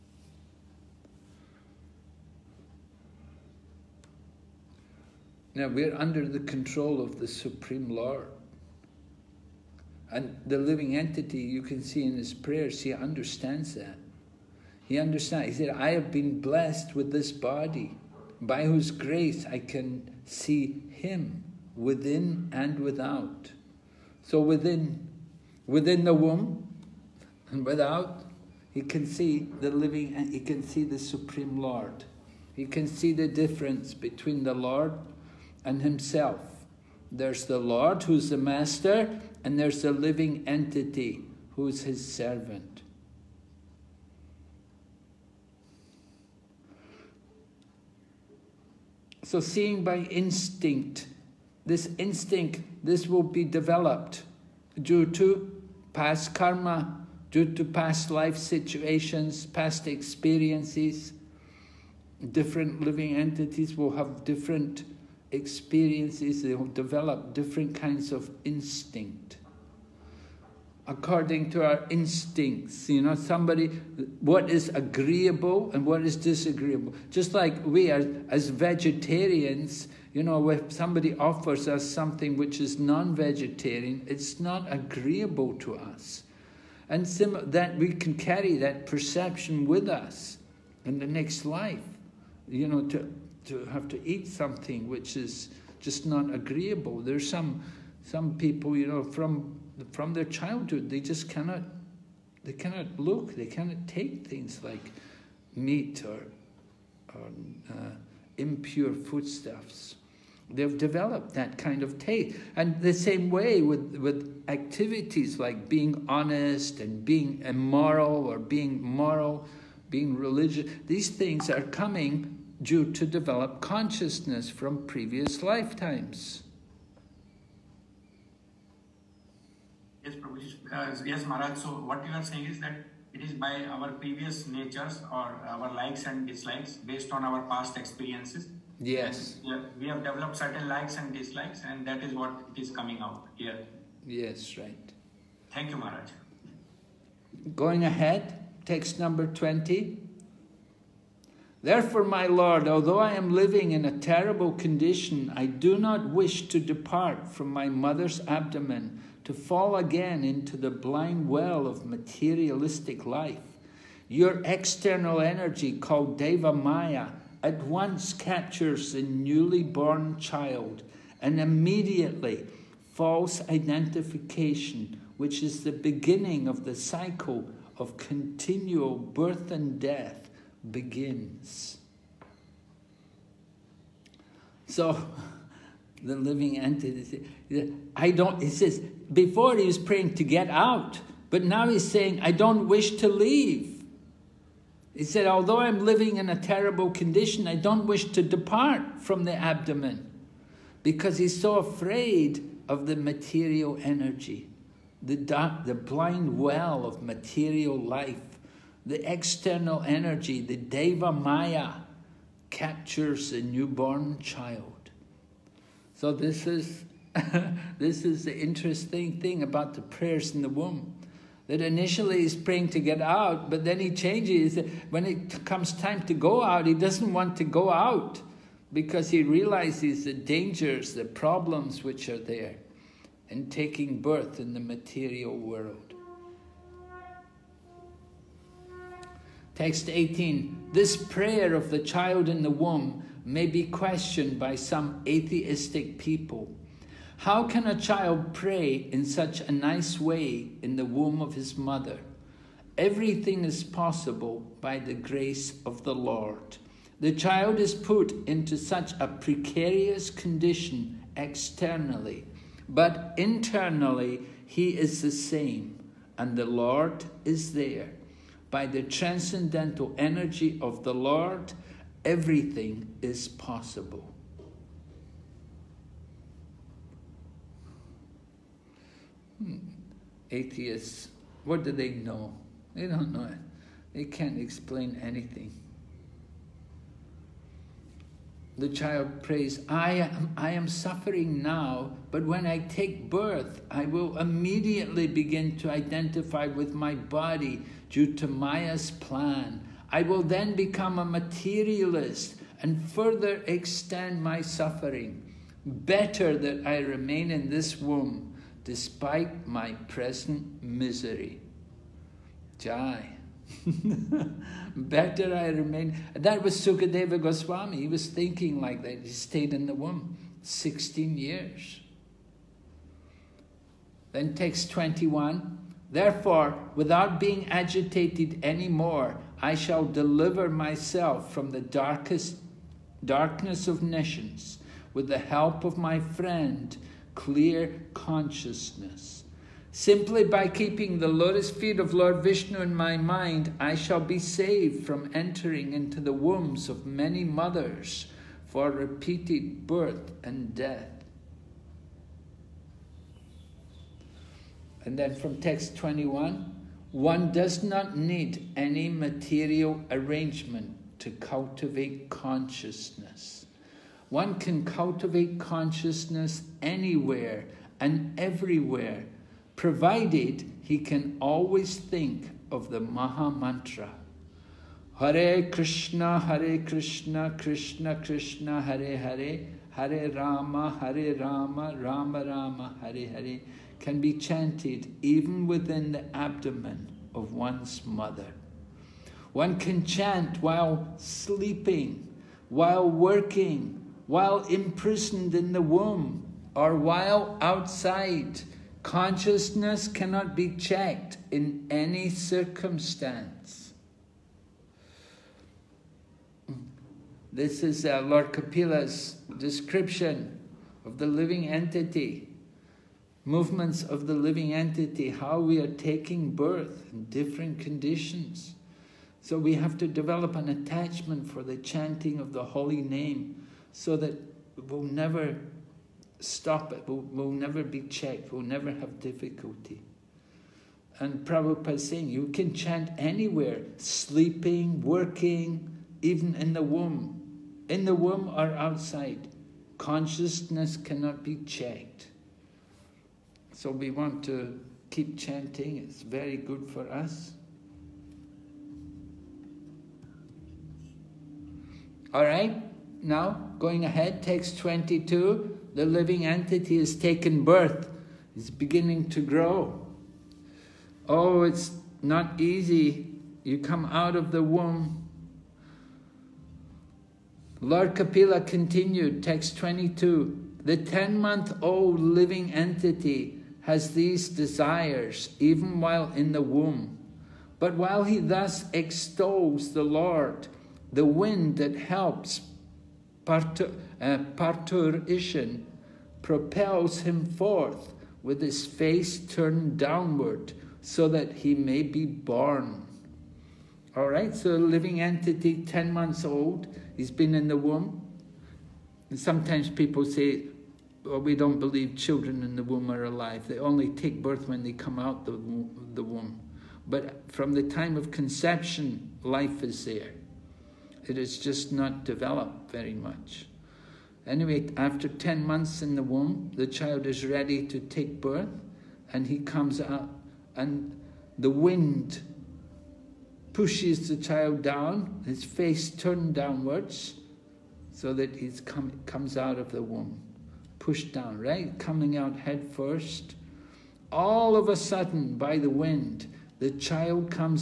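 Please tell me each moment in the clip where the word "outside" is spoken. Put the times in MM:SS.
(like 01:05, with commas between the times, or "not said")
06:37, 07:18.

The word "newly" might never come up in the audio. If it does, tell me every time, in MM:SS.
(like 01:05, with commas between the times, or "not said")
02:49.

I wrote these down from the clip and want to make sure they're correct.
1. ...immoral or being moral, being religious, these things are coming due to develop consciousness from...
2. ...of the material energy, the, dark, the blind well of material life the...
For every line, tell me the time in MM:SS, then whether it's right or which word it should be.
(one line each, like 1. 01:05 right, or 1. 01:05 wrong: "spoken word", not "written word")
1. 01:57 right
2. 03:22 right.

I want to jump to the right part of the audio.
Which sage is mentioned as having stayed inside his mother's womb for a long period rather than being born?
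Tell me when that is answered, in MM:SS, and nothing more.
05:16.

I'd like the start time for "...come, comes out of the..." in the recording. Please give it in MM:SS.
08:48.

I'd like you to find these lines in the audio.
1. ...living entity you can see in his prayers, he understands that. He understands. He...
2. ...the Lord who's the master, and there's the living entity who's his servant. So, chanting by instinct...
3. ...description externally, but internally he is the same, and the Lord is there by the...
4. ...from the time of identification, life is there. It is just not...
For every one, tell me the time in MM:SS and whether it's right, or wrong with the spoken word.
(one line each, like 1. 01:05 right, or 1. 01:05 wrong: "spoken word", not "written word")
1. 00:10 right
2. 00:37 wrong: "seeing", not "chanting"
3. 04:20 wrong: "condition", not "description"
4. 08:27 wrong: "conception", not "identification".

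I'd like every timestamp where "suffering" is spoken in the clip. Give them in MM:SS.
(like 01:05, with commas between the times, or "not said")
04:50, 05:04.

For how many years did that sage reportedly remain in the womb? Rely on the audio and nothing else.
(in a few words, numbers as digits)
16.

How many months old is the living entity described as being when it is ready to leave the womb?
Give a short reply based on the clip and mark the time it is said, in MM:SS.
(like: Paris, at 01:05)
10, at 07:50.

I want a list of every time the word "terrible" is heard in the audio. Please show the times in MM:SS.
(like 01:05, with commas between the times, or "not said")
02:33, 03:16.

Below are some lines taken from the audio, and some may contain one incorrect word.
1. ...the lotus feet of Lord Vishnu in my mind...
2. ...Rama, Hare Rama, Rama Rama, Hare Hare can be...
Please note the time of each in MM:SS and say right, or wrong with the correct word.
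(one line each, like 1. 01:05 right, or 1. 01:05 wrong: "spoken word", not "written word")
1. 05:40 right
2. 06:20 right.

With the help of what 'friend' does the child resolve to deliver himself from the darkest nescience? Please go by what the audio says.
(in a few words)
clear consciousness.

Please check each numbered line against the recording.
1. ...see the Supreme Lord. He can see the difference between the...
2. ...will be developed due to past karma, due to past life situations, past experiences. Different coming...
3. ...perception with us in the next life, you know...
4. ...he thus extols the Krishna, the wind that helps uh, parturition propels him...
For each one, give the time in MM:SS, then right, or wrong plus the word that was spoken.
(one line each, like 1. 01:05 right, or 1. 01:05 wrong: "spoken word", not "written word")
1. 00:30 right
2. 00:53 wrong: "living", not "coming"
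3. 01:28 right
4. 07:58 wrong: "Lord", not "Krishna".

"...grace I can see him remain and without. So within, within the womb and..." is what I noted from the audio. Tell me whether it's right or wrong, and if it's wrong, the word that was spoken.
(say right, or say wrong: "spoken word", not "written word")
wrong: "within", not "remain".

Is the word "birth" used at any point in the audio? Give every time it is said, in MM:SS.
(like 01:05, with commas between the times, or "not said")
02:58, 03:54, 04:53, 05:49, 06:56, 07:37, 08:24, 08:38.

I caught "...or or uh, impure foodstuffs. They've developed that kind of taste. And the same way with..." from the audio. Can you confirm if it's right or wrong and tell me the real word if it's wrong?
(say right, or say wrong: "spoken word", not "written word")
right.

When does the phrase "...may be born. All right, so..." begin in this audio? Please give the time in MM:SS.
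08:11.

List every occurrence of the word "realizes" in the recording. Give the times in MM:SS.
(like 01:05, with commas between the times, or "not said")
03:49.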